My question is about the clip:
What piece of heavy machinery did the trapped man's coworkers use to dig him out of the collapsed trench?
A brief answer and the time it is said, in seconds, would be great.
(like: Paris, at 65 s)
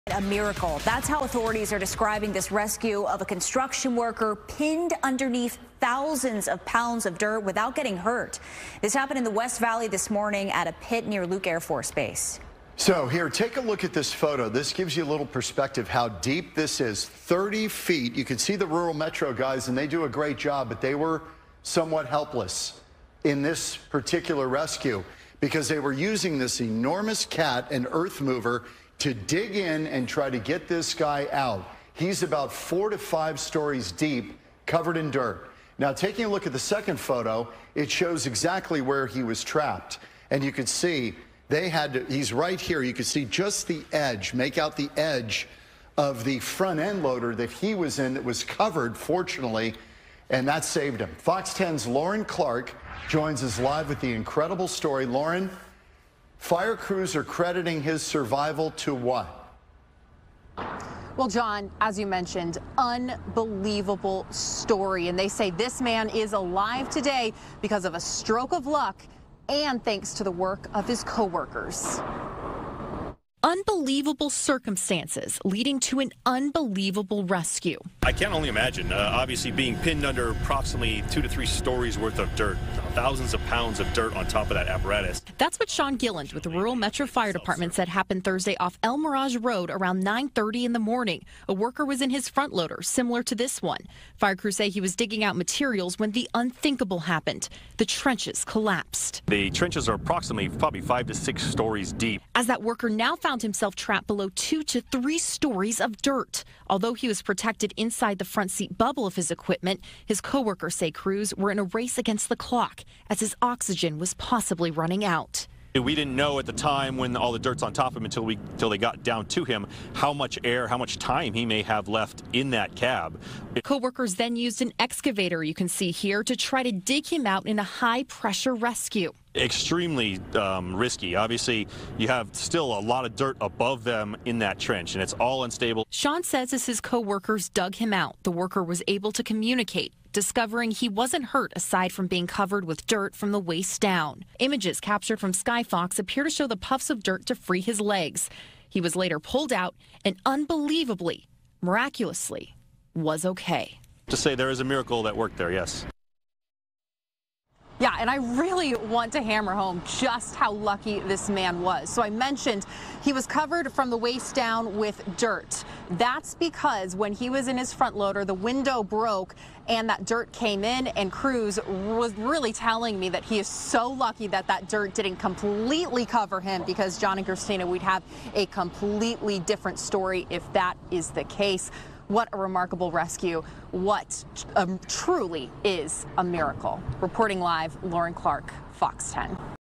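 An excavator, at 124 s.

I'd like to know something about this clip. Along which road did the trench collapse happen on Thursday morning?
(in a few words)
El Mirage Road.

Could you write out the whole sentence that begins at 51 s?
Fox 10's Lauren Clark joins us live with the incredible story.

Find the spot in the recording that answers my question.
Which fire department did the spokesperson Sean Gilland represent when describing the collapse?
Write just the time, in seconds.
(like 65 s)
86 s.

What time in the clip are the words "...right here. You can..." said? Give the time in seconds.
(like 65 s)
42 s.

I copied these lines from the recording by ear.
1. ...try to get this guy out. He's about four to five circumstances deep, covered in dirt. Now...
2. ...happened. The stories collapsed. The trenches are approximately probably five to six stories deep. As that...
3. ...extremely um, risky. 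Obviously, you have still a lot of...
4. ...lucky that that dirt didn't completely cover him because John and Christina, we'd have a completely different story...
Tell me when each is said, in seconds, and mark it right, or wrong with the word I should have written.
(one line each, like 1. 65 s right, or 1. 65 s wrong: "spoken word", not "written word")
1. 30 s wrong: "stories", not "circumstances"
2. 96 s wrong: "trenches", not "stories"
3. 129 s right
4. 173 s right.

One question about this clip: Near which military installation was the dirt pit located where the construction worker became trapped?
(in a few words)
Luke Air Force Base.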